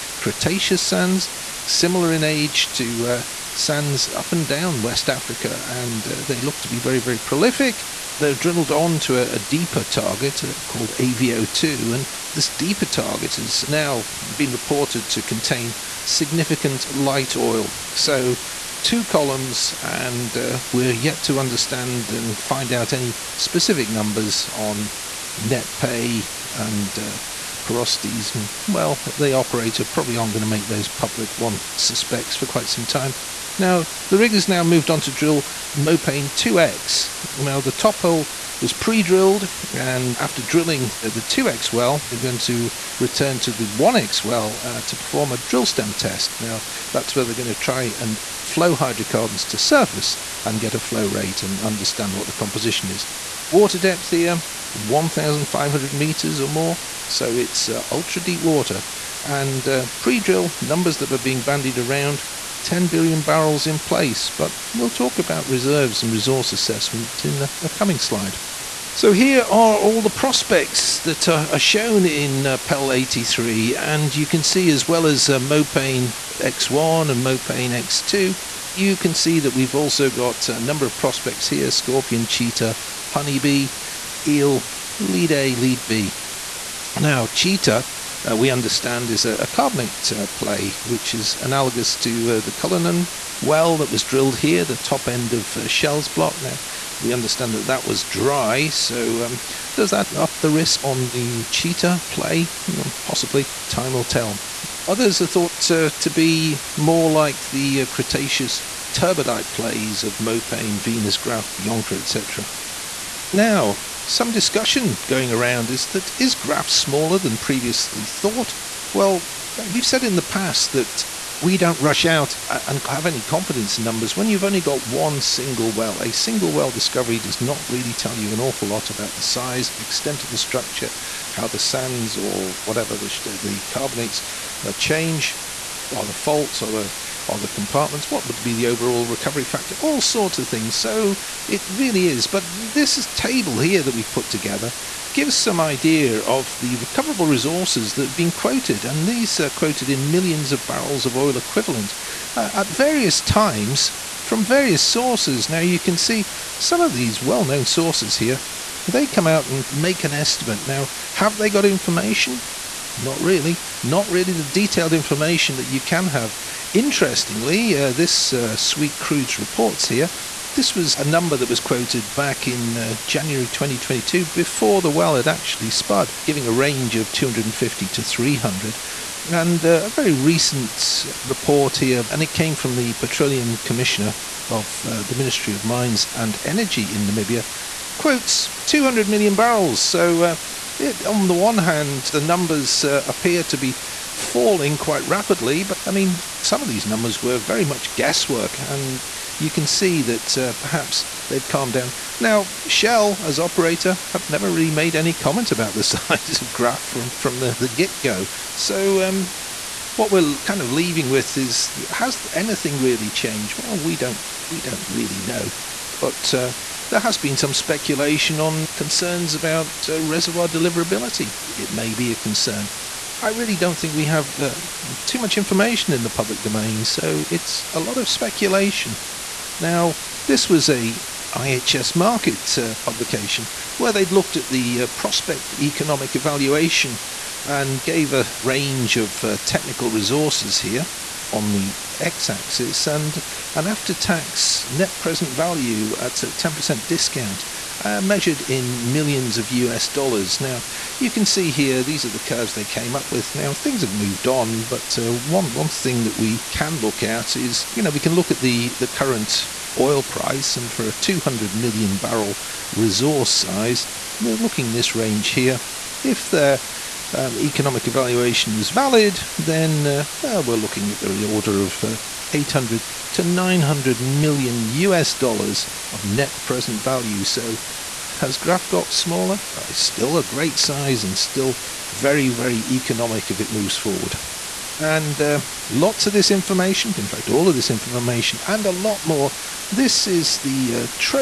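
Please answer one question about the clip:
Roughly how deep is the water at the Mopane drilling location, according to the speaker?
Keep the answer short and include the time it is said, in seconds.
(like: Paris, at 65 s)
1,500 meters, at 54 s.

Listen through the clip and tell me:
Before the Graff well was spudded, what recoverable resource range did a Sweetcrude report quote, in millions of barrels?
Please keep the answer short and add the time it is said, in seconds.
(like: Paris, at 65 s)
250 to 300, at 177 s.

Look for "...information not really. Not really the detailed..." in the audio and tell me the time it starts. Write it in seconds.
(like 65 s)
161 s.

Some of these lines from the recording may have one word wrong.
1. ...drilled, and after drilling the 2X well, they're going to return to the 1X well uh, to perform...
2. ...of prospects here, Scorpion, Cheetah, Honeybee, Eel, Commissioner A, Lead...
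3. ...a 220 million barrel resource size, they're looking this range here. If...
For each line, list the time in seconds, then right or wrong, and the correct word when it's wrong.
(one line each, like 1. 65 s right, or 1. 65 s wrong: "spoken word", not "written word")
1. 39 s right
2. 80 s wrong: "Lead", not "Commissioner"
3. 260 s wrong: "200", not "220".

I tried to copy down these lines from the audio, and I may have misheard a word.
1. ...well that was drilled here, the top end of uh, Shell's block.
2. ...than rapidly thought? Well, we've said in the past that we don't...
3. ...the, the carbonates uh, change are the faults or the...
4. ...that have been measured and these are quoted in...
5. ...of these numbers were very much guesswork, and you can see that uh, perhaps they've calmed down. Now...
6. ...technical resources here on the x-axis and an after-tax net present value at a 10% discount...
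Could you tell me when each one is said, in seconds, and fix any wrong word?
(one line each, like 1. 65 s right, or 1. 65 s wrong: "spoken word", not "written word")
1. 93 s right
2. 117 s wrong: "previously", not "rapidly"
3. 132 s right
4. 147 s wrong: "quoted", not "measured"
5. 196 s right
6. 239 s right.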